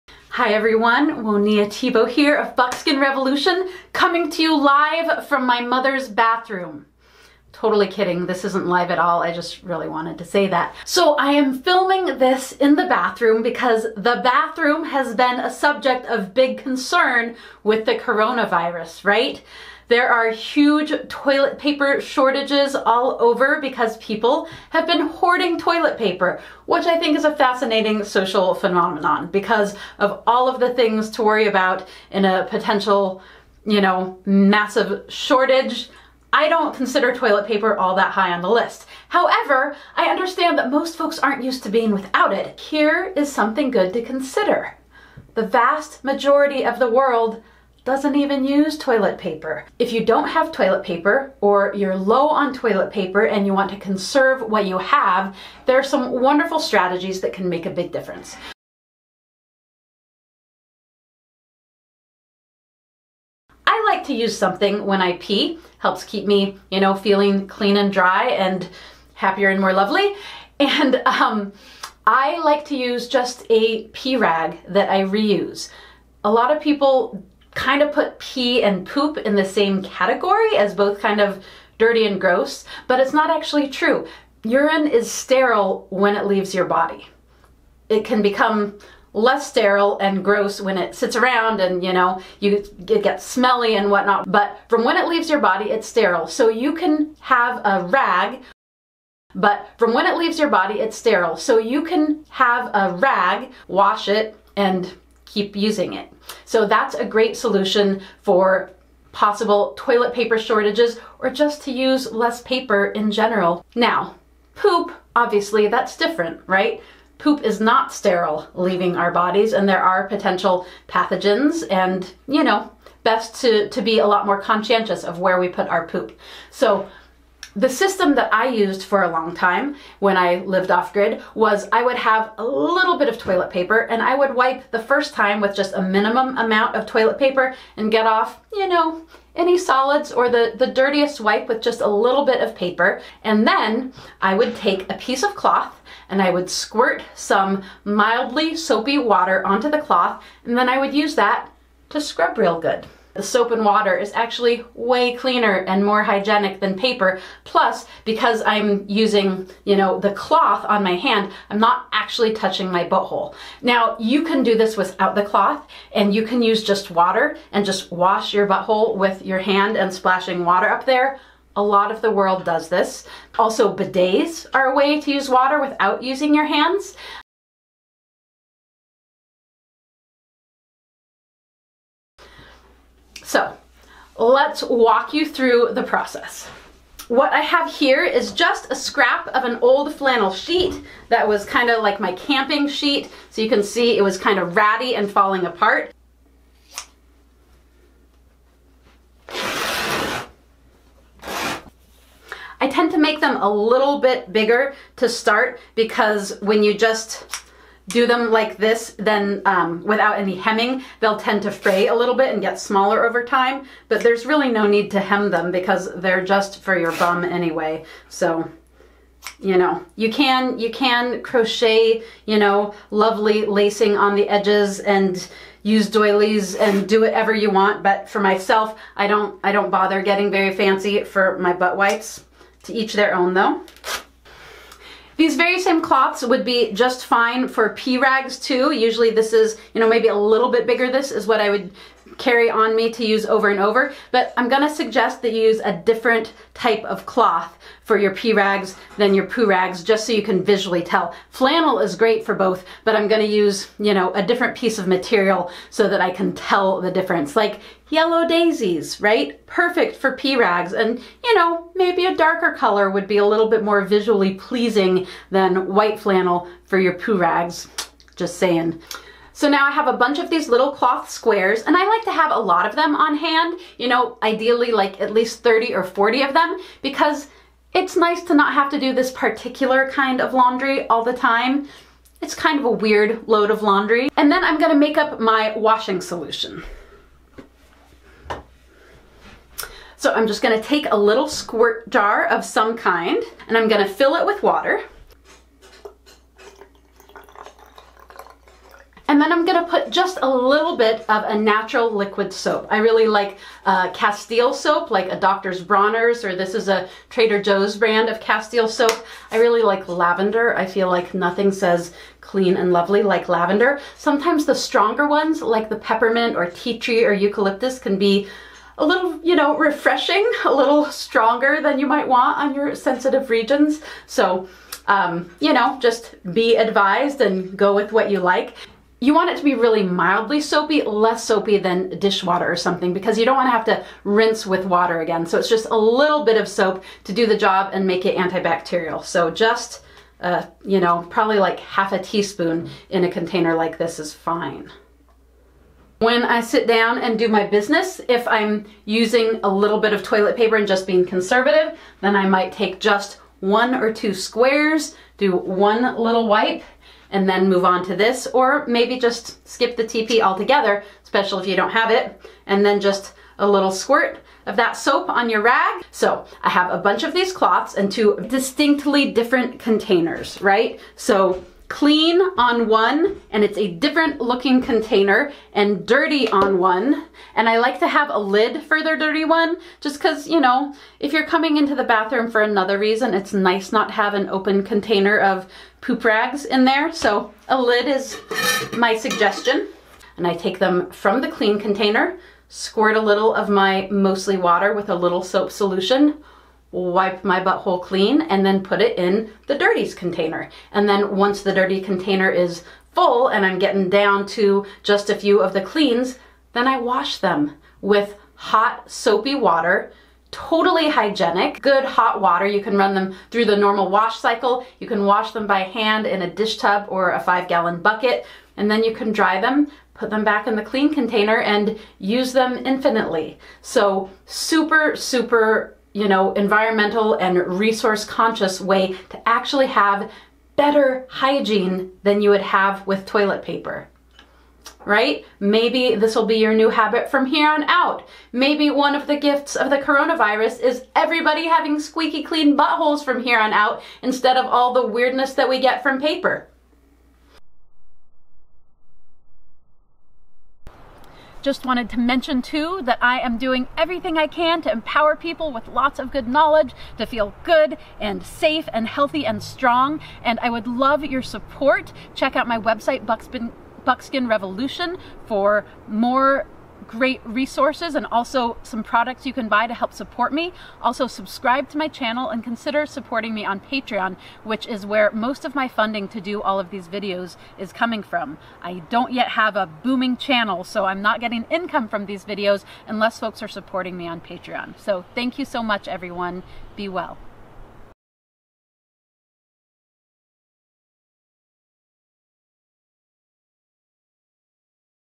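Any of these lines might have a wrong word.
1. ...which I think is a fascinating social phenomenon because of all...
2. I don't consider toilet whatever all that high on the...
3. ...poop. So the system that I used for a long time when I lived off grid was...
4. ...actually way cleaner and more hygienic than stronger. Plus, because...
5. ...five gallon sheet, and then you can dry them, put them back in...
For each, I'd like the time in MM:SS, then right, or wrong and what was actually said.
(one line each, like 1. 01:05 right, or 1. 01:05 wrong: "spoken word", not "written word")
1. 00:26 right
2. 00:36 wrong: "paper", not "whatever"
3. 02:05 right
4. 02:34 wrong: "paper", not "stronger"
5. 06:57 wrong: "bucket", not "sheet".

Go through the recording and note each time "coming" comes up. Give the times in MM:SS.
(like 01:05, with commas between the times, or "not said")
00:03, 06:21, 07:57.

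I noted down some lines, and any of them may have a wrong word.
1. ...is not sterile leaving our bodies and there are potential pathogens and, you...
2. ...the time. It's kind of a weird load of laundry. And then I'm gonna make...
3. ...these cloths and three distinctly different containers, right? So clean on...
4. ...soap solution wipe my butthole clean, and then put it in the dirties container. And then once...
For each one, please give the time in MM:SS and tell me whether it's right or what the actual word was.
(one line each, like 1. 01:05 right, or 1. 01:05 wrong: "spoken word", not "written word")
1. 01:57 right
2. 04:41 right
3. 06:07 wrong: "two", not "three"
4. 06:35 right.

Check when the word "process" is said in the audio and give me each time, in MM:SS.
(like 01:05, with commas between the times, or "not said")
03:05.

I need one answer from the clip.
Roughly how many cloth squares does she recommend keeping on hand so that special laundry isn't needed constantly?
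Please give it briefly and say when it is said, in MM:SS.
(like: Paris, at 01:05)
30 or 40, at 04:35.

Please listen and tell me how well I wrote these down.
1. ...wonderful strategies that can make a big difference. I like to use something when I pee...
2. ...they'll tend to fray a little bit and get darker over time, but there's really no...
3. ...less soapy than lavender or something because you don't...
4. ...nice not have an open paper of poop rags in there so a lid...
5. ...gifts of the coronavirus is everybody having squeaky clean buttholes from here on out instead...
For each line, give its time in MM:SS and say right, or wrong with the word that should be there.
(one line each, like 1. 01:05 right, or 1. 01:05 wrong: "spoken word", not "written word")
1. 00:56 right
2. 03:30 wrong: "smaller", not "darker"
3. 05:30 wrong: "dishwater", not "lavender"
4. 06:23 wrong: "container", not "paper"
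5. 07:19 right.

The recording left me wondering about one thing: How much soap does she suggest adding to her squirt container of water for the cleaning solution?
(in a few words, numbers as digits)
Half a teaspoon.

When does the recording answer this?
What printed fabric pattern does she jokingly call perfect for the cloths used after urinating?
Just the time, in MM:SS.
04:17.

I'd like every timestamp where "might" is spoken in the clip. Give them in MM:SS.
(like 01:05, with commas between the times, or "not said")
05:21, 05:52.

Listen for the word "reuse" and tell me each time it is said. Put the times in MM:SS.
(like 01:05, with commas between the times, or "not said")
01:15.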